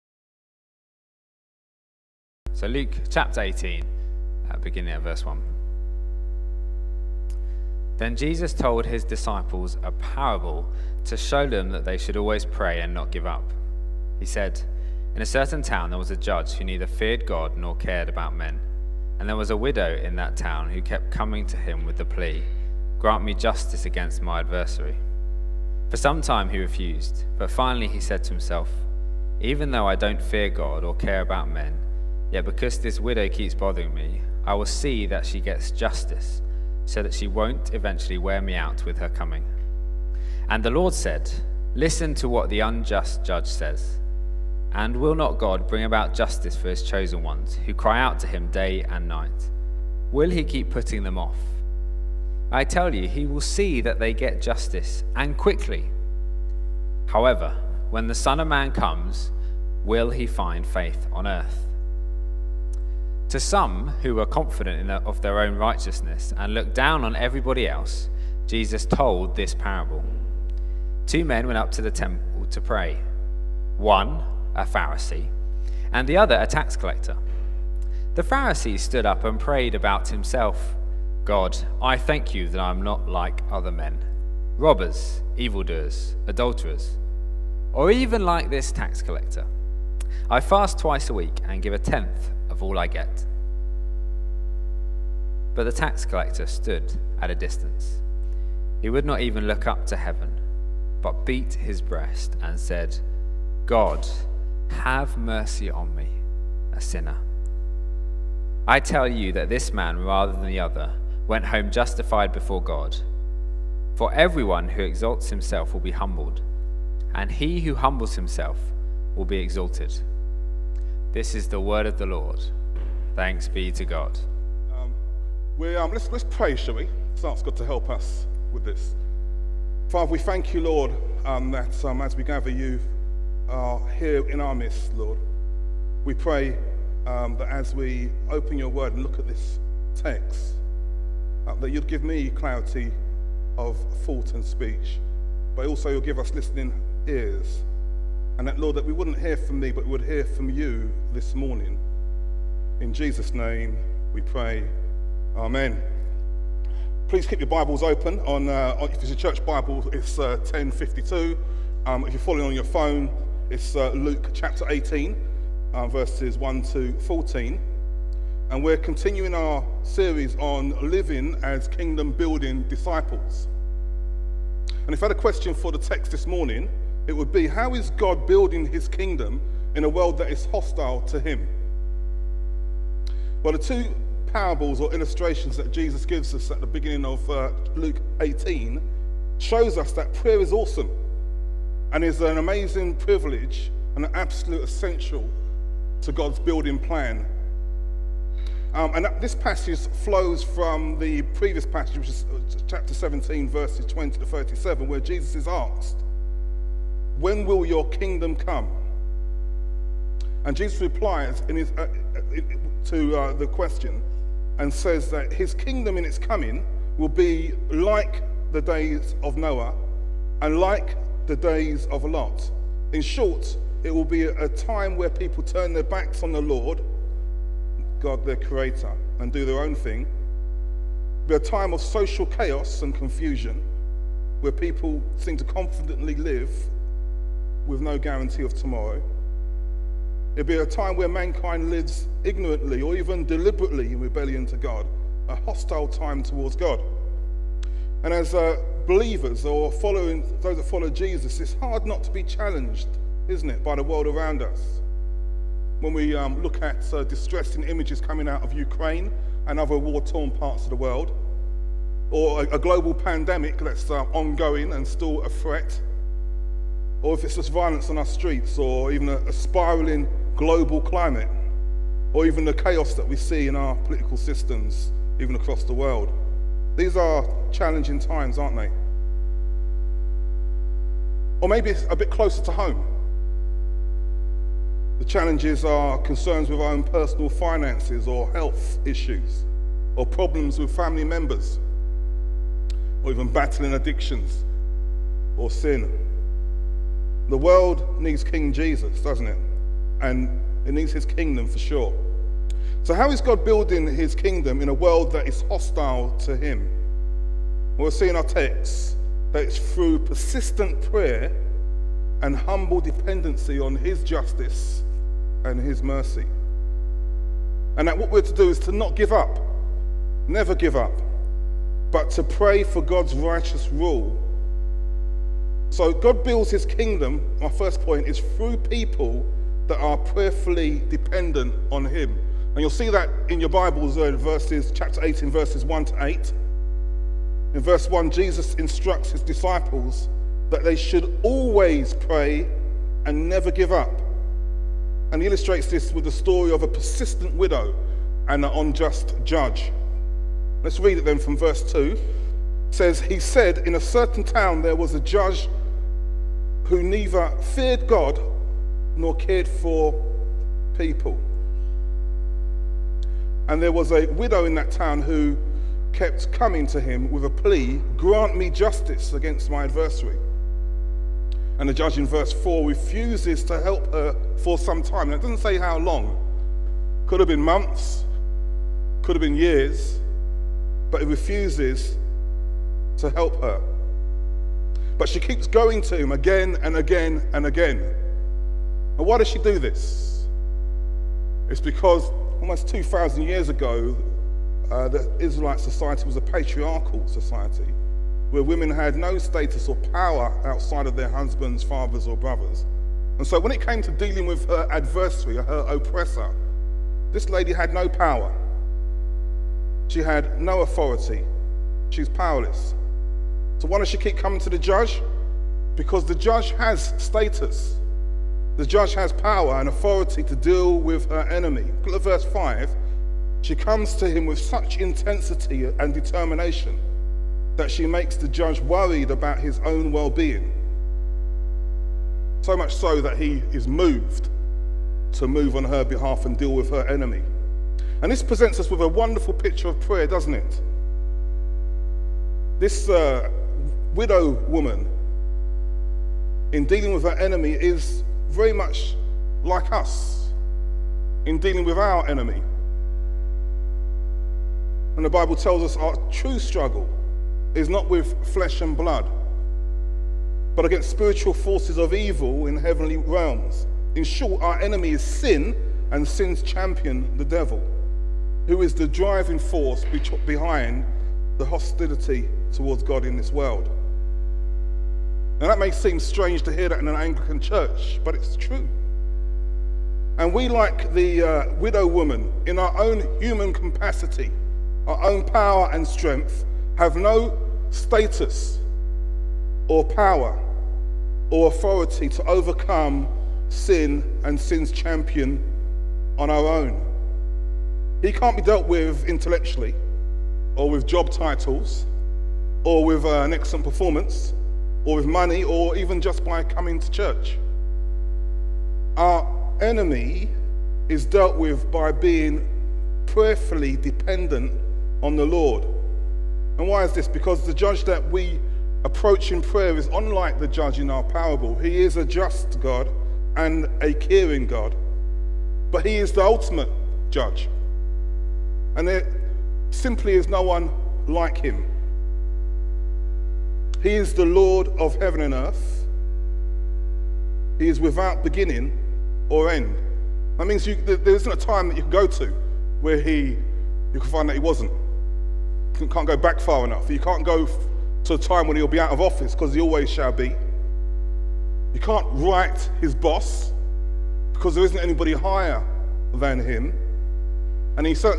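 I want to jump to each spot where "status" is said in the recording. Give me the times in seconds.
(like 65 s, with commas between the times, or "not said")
399 s, 416 s, 487 s.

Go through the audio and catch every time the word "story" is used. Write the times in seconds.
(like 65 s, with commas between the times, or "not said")
346 s.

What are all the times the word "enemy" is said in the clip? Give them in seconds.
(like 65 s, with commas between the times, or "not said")
421 s, 436 s, 447 s, 452 s, 464 s, 509 s.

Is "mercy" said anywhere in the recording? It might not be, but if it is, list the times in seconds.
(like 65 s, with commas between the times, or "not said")
105 s, 315 s.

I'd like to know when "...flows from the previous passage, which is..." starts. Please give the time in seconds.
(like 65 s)
200 s.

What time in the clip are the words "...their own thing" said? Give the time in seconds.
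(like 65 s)
229 s.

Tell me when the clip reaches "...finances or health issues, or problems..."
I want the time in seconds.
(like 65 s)
287 s.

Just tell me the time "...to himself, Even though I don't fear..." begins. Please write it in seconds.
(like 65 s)
28 s.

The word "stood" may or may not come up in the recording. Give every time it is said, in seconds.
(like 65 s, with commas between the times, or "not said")
78 s, 96 s.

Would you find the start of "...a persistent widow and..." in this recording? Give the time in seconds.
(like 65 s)
346 s.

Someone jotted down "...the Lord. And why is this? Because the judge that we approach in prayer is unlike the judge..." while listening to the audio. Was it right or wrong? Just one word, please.
right.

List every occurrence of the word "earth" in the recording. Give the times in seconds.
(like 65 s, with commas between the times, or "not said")
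61 s, 535 s.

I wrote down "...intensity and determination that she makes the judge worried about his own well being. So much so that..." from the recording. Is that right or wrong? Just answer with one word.
right.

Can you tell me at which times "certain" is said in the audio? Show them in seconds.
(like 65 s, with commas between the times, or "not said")
15 s, 353 s.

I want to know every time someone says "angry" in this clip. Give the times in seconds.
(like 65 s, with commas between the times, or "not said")
not said.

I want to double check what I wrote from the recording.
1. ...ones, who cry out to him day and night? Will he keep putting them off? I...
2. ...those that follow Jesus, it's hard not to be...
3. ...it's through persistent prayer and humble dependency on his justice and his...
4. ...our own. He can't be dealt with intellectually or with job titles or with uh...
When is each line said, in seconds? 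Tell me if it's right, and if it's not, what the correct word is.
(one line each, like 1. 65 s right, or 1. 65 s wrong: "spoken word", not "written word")
1. 47 s right
2. 250 s right
3. 309 s right
4. 496 s right.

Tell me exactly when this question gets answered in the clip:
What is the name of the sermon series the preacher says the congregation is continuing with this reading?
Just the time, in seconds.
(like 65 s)
170 s.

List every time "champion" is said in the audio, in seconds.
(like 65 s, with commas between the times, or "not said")
466 s, 494 s.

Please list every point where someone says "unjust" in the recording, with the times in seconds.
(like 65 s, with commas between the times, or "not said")
42 s, 348 s.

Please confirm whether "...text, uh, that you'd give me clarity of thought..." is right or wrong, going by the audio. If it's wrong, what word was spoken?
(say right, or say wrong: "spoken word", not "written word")
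right.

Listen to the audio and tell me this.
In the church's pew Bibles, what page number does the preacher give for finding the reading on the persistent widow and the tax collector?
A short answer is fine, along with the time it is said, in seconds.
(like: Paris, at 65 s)
1052, at 160 s.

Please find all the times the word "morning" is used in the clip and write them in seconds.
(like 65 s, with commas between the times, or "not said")
151 s, 176 s.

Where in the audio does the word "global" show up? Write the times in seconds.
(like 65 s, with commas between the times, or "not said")
262 s, 270 s.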